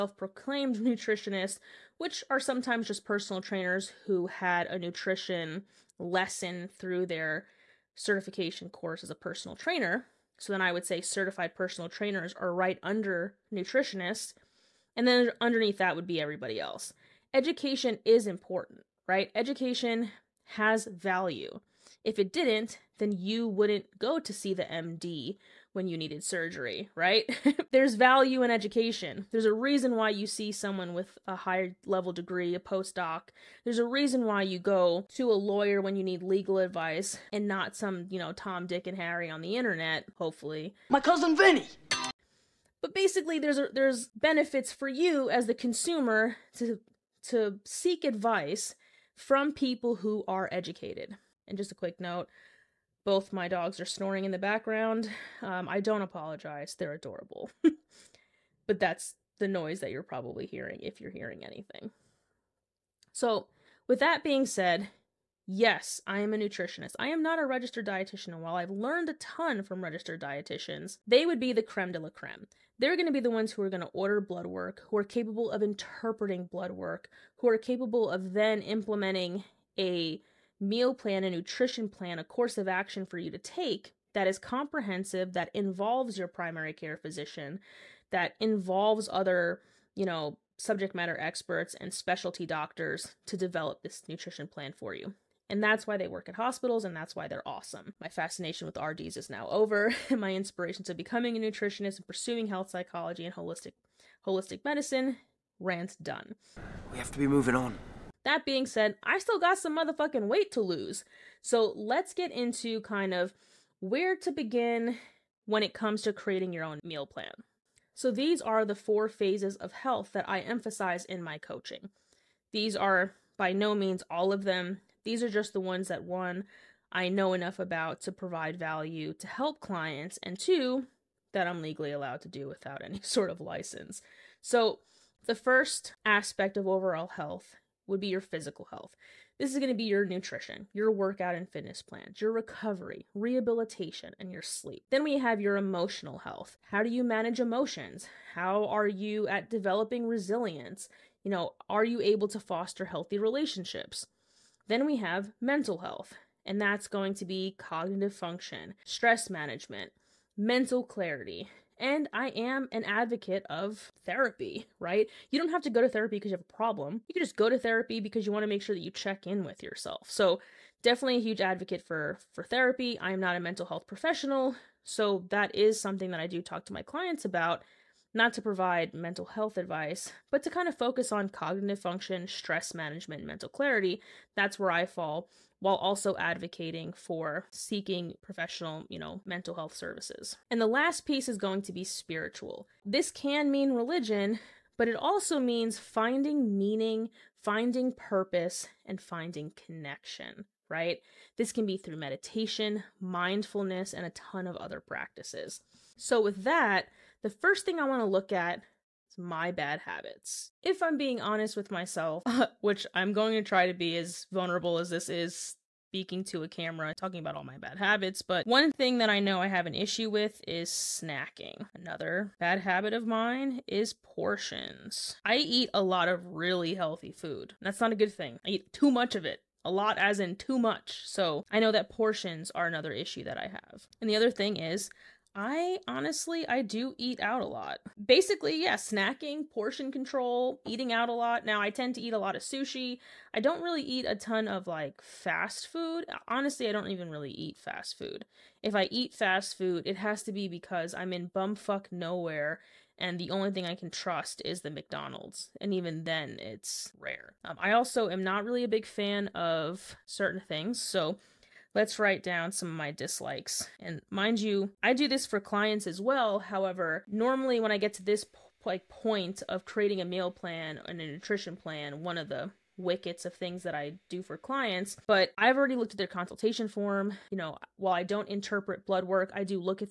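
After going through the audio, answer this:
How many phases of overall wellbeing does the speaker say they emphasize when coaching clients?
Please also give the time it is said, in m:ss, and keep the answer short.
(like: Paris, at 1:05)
4, at 1:58.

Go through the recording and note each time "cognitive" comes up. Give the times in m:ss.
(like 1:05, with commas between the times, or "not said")
2:37, 3:01.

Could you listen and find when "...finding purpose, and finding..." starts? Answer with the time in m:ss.
3:17.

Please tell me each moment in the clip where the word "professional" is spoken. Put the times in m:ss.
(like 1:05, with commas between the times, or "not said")
2:53, 3:08.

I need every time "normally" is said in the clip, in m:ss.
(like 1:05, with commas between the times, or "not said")
4:27.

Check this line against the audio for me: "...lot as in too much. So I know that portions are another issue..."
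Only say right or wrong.
right.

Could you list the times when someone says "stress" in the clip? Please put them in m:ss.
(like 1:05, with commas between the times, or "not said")
2:38, 3:02.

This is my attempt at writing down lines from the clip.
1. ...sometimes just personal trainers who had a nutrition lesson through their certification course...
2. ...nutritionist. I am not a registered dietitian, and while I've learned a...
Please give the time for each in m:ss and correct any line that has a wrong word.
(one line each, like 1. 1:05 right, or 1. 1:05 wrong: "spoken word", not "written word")
1. 0:02 right
2. 1:06 right.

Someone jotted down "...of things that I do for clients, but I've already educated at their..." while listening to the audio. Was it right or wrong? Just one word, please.
wrong.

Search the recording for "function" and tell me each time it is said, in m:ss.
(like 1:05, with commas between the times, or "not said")
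2:38, 3:01.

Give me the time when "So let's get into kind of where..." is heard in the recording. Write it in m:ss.
1:51.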